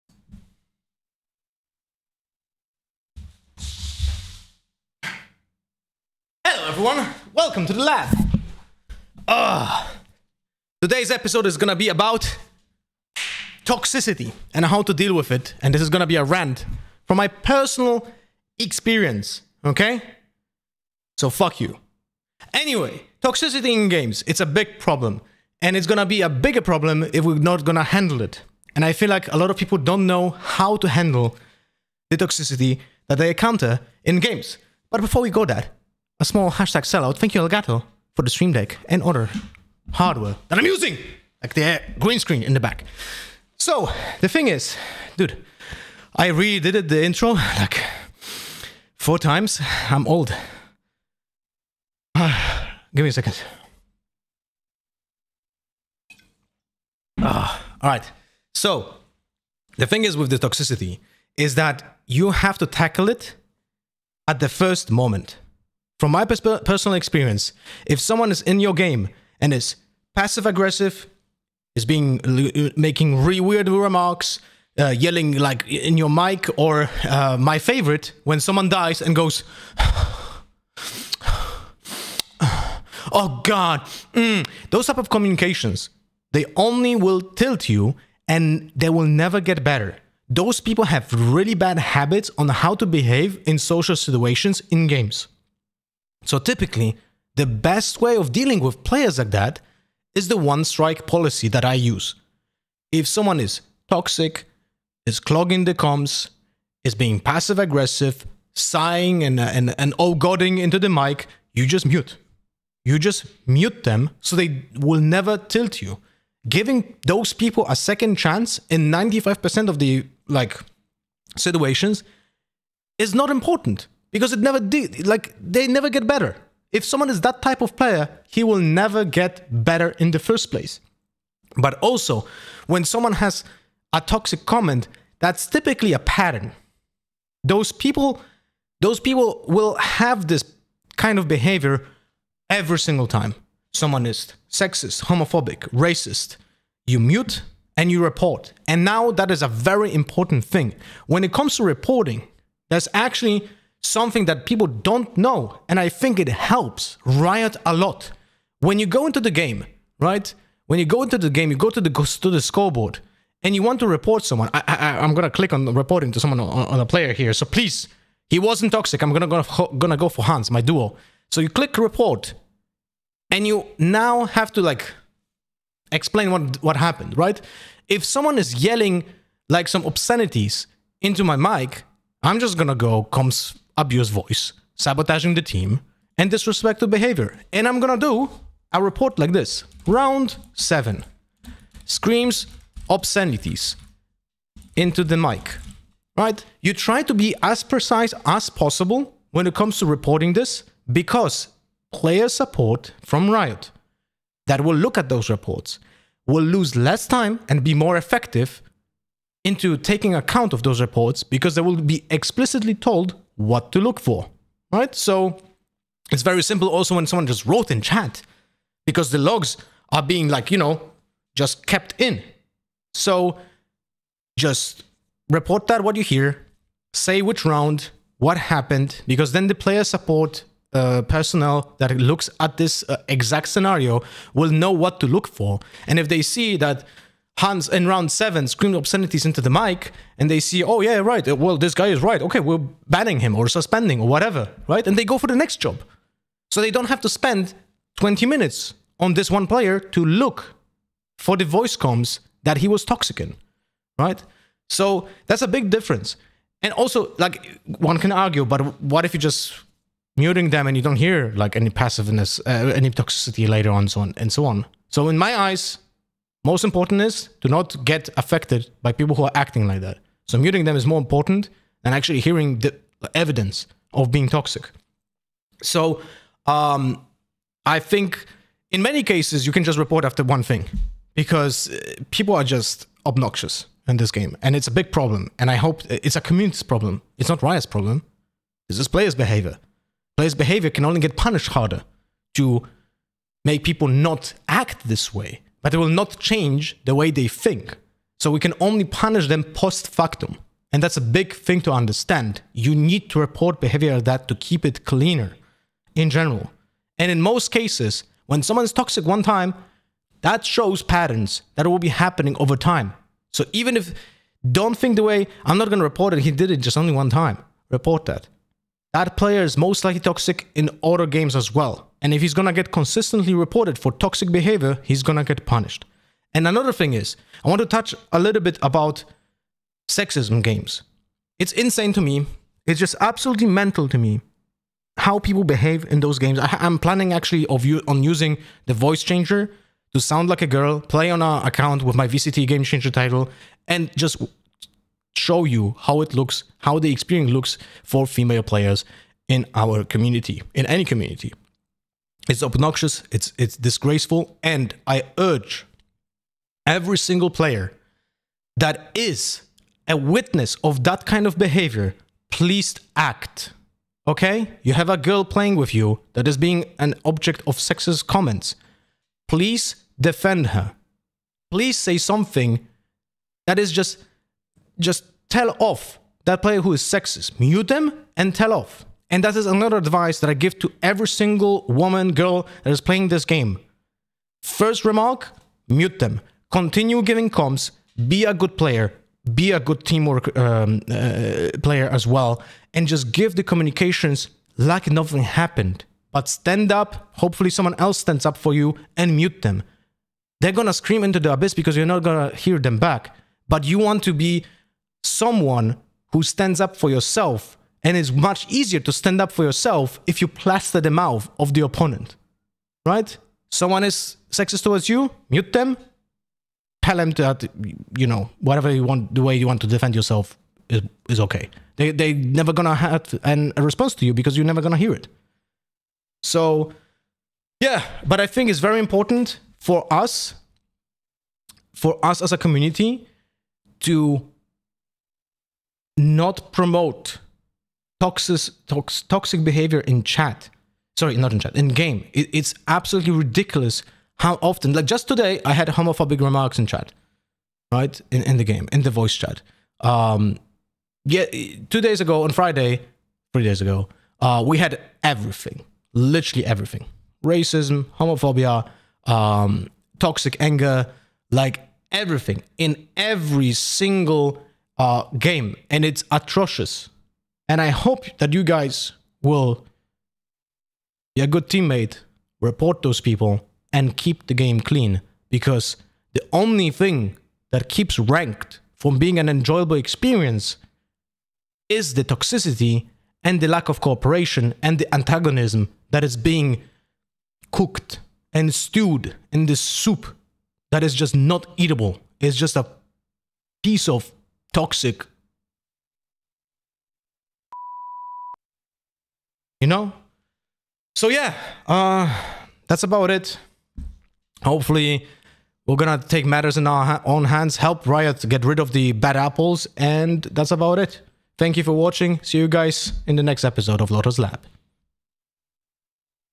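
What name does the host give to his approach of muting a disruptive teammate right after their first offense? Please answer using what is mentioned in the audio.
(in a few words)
one strike policy.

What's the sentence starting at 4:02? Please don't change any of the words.
Okay, we're banning him or suspending or whatever, right?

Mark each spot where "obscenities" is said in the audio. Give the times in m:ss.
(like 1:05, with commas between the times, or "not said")
2:59, 3:12, 3:58.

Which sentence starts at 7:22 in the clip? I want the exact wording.
It, it's absolutely ridiculous how often, like just today, I had homophobic remarks in chat, right?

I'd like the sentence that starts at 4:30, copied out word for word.
So muting them is more important than actually hearing the evidence of being toxic.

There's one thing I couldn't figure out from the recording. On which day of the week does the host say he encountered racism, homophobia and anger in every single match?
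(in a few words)
Friday.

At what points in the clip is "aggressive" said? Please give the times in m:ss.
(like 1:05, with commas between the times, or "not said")
1:10, 1:47.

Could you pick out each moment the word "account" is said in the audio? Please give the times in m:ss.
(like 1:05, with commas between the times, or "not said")
3:30, 5:41.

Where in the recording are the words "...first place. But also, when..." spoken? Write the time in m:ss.
2:10.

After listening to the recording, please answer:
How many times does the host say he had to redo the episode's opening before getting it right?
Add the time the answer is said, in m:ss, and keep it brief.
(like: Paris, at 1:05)
4, at 0:48.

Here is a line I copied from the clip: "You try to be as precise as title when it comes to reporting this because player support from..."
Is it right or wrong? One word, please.
wrong.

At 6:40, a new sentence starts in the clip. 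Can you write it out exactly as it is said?
They're gonna scream into the abyss because you're not gonna hear them back.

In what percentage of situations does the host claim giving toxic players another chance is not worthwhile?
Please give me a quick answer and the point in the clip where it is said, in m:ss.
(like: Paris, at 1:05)
95%, at 1:58.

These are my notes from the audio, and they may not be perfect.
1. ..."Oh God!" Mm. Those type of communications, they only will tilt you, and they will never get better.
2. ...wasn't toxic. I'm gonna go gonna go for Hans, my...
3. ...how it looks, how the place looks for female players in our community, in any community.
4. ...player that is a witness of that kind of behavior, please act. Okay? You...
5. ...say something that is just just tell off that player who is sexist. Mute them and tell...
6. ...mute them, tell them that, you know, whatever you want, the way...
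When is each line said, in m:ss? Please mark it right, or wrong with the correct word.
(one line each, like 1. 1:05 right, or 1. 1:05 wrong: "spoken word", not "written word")
1. 1:23 right
2. 2:48 right
3. 5:45 wrong: "experience", not "place"
4. 5:57 right
5. 6:11 right
6. 6:55 right.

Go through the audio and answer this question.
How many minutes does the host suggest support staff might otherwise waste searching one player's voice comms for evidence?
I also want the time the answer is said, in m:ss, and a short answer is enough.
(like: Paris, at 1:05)
20 minutes, at 4:07.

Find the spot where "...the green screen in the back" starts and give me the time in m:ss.
0:41.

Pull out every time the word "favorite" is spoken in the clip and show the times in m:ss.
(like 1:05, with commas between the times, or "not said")
1:17.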